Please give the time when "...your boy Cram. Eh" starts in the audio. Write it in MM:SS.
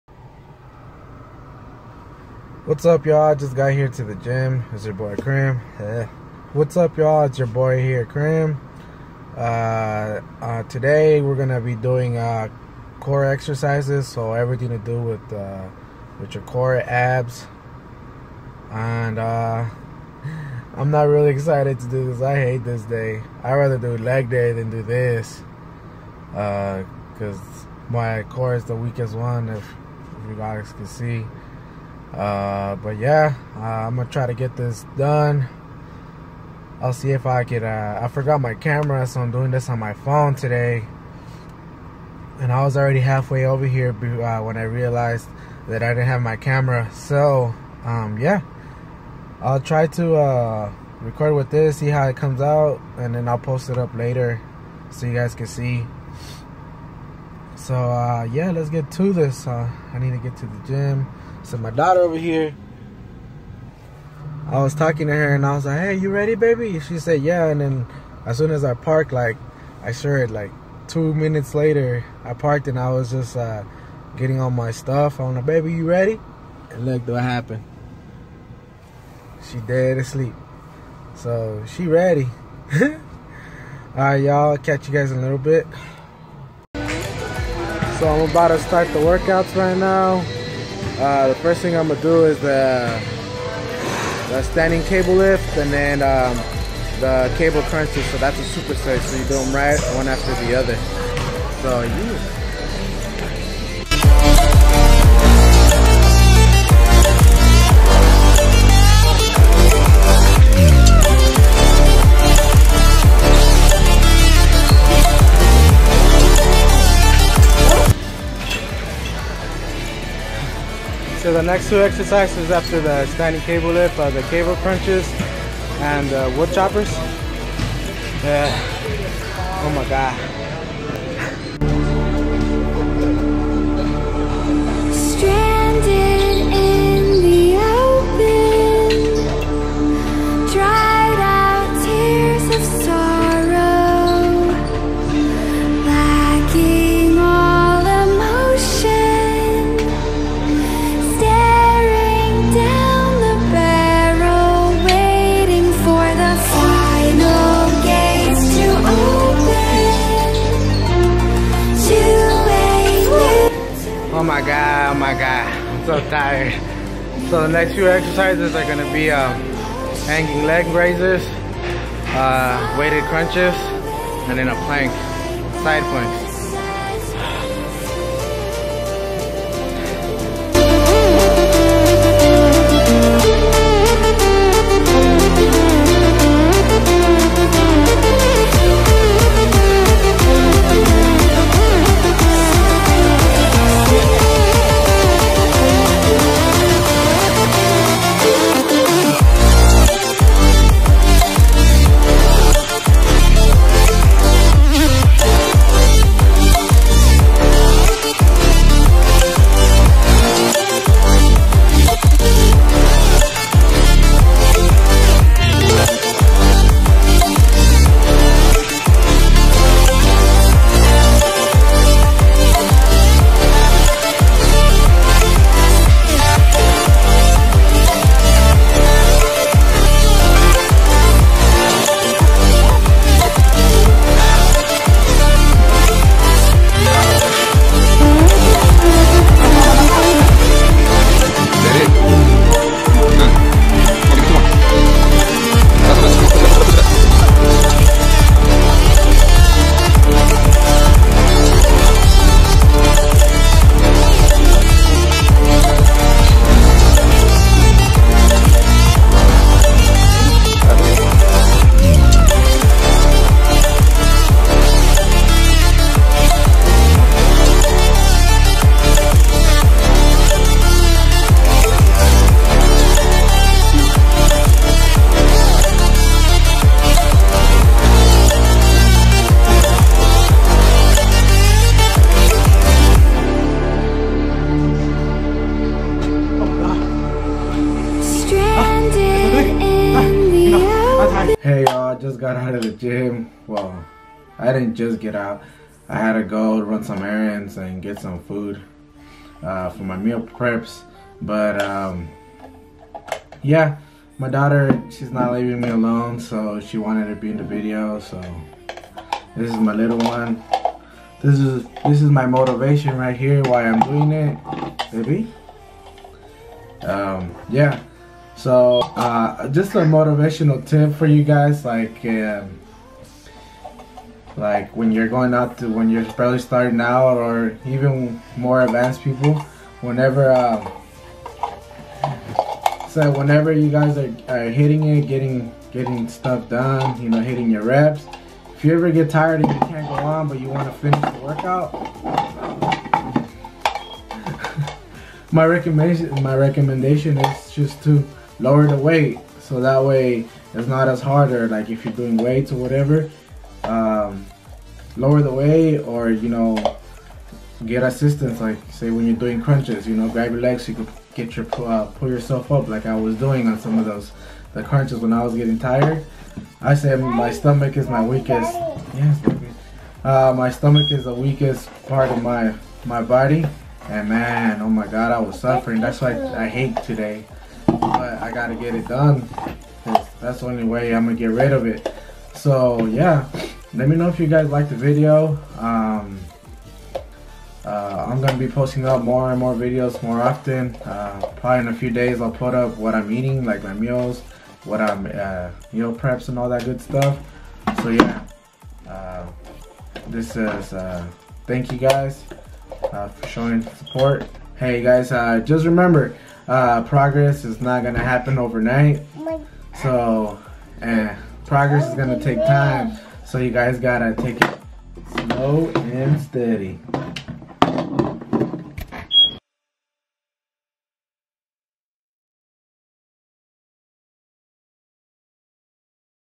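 00:04.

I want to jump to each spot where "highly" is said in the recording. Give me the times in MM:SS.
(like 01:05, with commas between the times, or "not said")
not said.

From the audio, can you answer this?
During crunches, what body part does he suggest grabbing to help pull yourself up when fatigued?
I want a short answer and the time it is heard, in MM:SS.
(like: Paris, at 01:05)
legs, at 06:00.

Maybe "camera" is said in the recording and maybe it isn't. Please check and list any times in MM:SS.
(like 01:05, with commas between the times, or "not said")
00:38, 00:46.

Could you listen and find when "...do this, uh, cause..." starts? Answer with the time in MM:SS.
00:24.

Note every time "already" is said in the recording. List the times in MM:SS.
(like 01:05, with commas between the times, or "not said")
00:42.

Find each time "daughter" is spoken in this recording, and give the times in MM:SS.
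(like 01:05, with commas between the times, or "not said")
01:01, 05:04.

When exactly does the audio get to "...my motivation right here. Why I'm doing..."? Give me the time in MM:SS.
05:12.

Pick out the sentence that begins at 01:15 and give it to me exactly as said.
I'm like, "Baby, you ready?" And look, what happened?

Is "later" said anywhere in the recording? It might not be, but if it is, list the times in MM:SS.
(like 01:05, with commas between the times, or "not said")
00:53, 01:11.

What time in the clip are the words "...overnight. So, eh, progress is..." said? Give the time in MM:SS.
06:48.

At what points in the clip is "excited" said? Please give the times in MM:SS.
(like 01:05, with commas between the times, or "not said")
00:21.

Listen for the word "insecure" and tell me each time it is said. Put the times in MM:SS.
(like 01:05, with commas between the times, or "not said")
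not said.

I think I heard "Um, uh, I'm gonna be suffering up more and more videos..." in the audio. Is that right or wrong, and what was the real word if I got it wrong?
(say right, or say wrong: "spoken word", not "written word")
wrong: "posting", not "suffering".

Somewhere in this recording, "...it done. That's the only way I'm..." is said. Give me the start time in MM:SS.
06:18.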